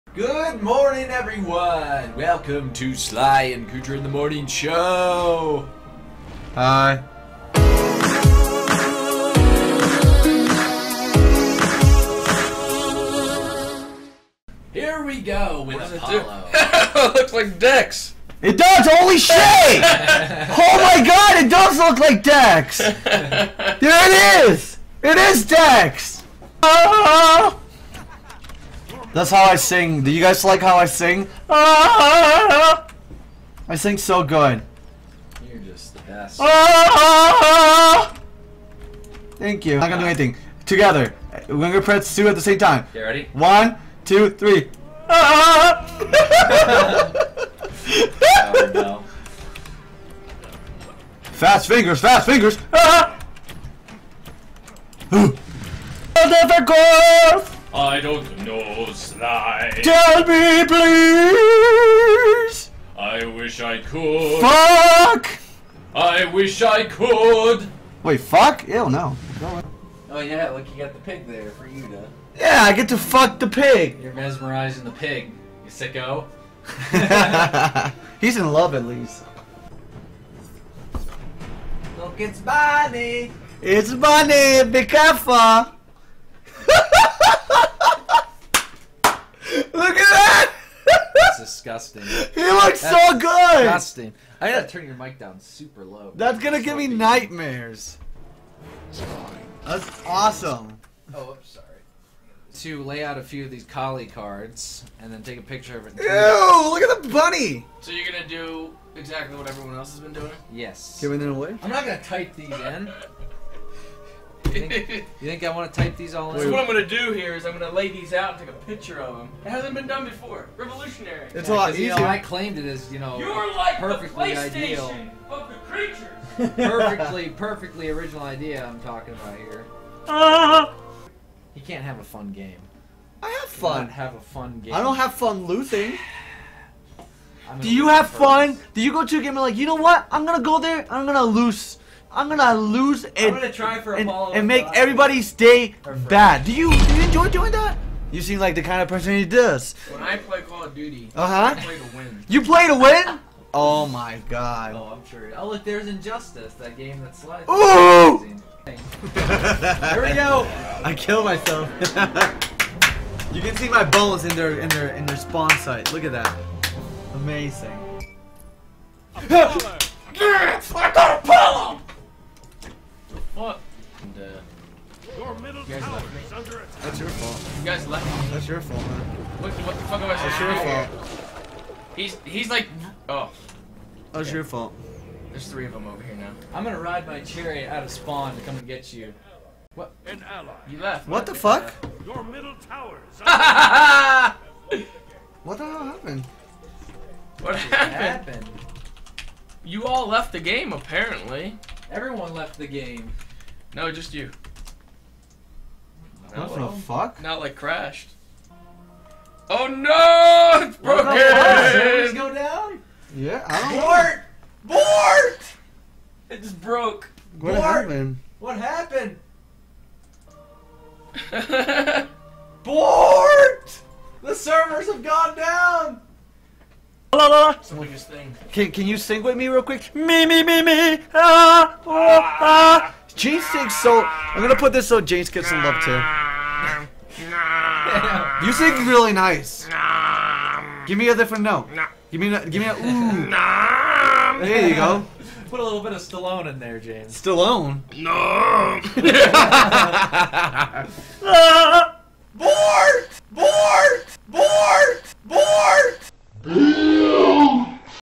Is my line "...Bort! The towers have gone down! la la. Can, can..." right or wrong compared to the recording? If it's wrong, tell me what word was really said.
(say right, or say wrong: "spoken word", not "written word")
wrong: "servers", not "towers".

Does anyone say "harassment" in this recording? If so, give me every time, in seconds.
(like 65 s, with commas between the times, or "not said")
not said.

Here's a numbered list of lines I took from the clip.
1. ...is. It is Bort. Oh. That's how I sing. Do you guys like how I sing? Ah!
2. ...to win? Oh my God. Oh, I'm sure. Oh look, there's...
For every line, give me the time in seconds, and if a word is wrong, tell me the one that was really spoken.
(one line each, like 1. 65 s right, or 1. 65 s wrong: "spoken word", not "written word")
1. 24 s wrong: "Dex", not "Bort"
2. 152 s right.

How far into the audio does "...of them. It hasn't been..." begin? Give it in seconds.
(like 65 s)
119 s.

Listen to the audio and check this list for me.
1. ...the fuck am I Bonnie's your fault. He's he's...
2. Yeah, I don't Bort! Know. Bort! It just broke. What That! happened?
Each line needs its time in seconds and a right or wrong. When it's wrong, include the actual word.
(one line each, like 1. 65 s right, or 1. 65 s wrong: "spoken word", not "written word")
1. 179 s wrong: "That", not "Bonnie"
2. 213 s wrong: "Bort", not "That".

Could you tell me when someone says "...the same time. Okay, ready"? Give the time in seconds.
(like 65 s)
42 s.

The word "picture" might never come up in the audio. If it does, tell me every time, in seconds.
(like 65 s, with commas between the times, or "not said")
105 s, 118 s.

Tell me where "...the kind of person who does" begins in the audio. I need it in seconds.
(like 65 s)
148 s.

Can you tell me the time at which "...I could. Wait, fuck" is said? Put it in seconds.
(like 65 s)
66 s.